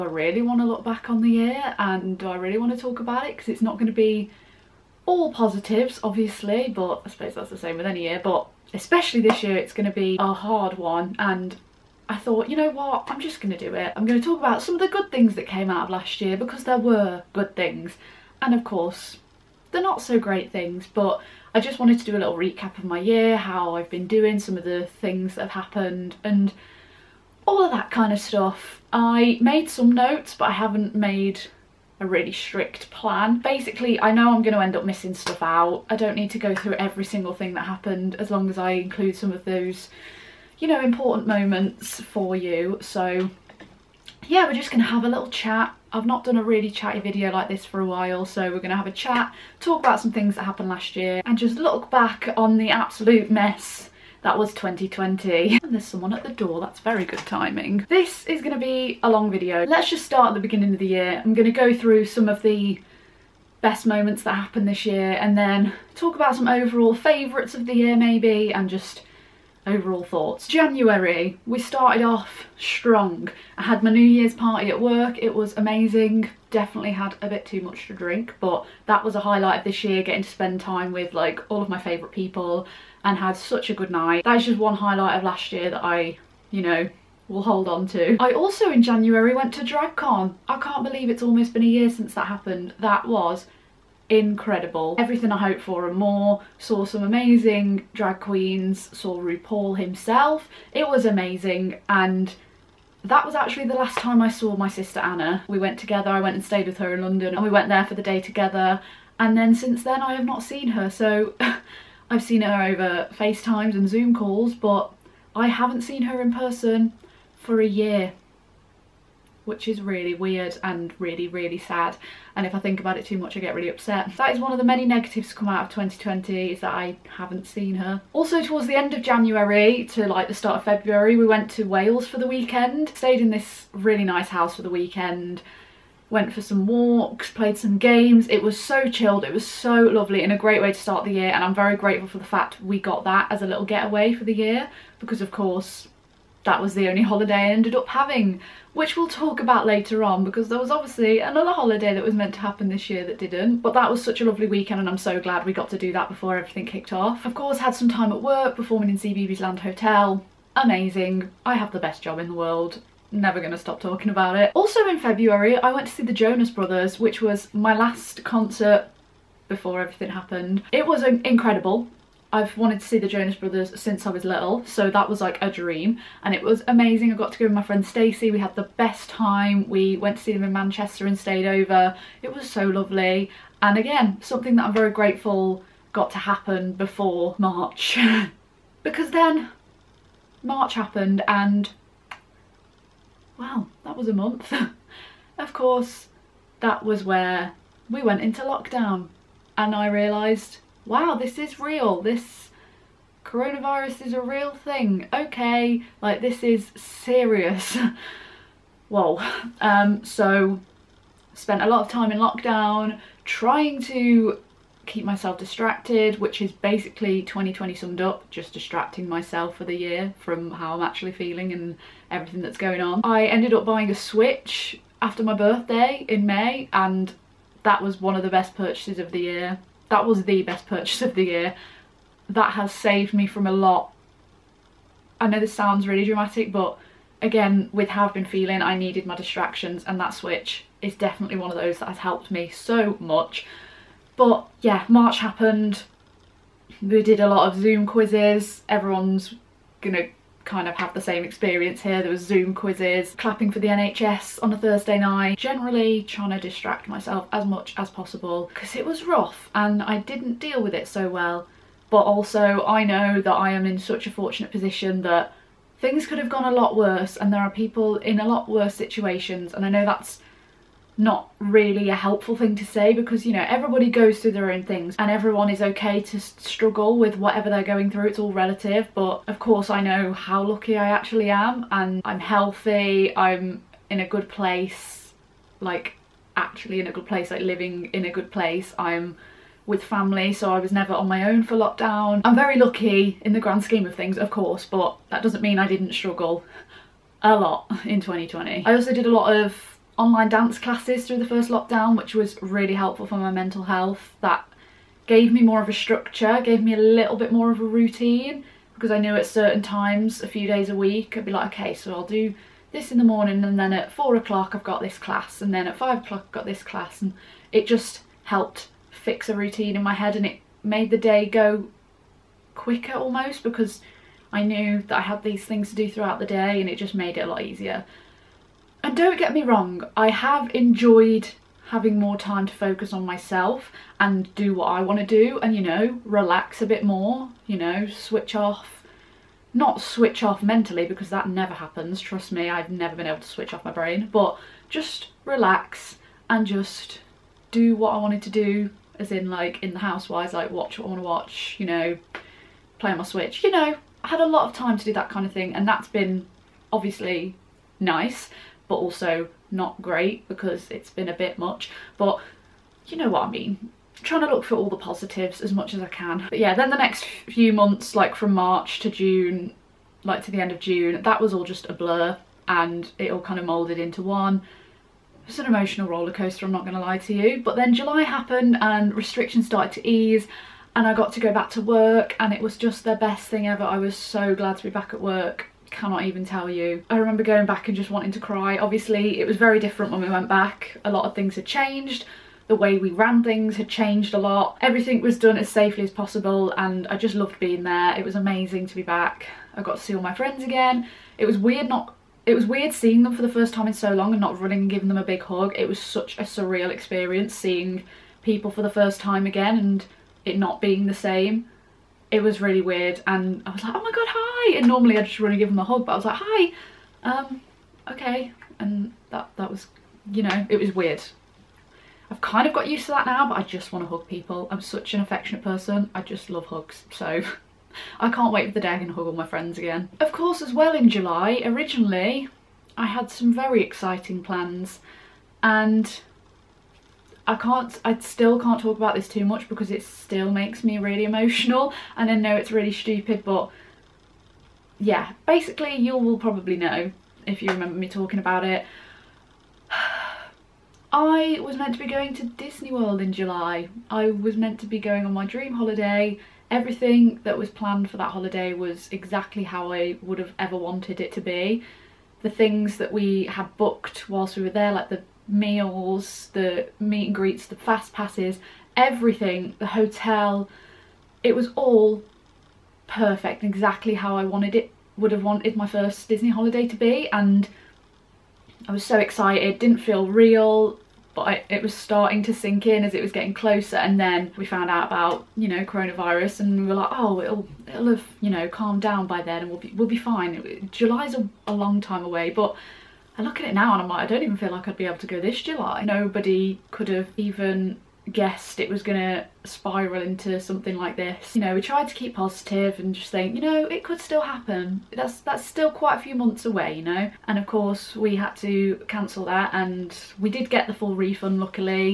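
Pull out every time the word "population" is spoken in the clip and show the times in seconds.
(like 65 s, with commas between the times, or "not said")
not said.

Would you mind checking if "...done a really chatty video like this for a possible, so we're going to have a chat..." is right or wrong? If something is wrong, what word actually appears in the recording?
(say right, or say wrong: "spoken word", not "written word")
wrong: "while", not "possible".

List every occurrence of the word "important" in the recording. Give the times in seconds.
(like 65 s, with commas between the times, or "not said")
40 s.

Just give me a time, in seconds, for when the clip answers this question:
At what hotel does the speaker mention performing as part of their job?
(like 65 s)
158 s.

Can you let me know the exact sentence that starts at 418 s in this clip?
And that, that was, you know, it was weird.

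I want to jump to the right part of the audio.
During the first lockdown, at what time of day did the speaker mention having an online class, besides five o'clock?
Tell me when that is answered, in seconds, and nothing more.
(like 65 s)
313 s.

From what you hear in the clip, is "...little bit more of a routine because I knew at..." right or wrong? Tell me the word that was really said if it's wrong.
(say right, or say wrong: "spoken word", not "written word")
right.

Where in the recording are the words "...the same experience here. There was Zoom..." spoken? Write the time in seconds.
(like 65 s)
250 s.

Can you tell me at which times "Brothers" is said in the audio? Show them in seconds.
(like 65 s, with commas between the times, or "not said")
166 s, 173 s.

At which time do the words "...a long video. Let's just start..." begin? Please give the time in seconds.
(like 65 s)
59 s.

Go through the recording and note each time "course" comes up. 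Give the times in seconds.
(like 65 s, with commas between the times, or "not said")
18 s, 145 s, 157 s, 195 s, 279 s, 294 s, 430 s, 507 s.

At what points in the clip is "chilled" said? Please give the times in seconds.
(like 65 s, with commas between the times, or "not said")
138 s.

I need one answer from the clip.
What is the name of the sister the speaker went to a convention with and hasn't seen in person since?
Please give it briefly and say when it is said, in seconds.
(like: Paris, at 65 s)
Anna, at 104 s.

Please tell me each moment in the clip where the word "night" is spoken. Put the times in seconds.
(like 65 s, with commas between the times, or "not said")
83 s, 254 s.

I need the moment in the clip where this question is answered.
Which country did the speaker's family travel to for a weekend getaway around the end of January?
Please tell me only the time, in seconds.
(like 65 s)
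131 s.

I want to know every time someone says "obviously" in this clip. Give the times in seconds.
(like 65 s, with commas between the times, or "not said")
6 s, 150 s, 356 s, 388 s.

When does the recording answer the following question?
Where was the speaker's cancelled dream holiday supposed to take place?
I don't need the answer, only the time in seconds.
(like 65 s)
452 s.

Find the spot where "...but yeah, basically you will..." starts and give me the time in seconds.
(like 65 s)
443 s.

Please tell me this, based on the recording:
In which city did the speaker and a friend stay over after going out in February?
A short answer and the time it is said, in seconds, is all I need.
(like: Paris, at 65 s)
Manchester, at 180 s.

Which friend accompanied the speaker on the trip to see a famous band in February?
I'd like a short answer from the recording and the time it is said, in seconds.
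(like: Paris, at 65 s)
Stacey, at 177 s.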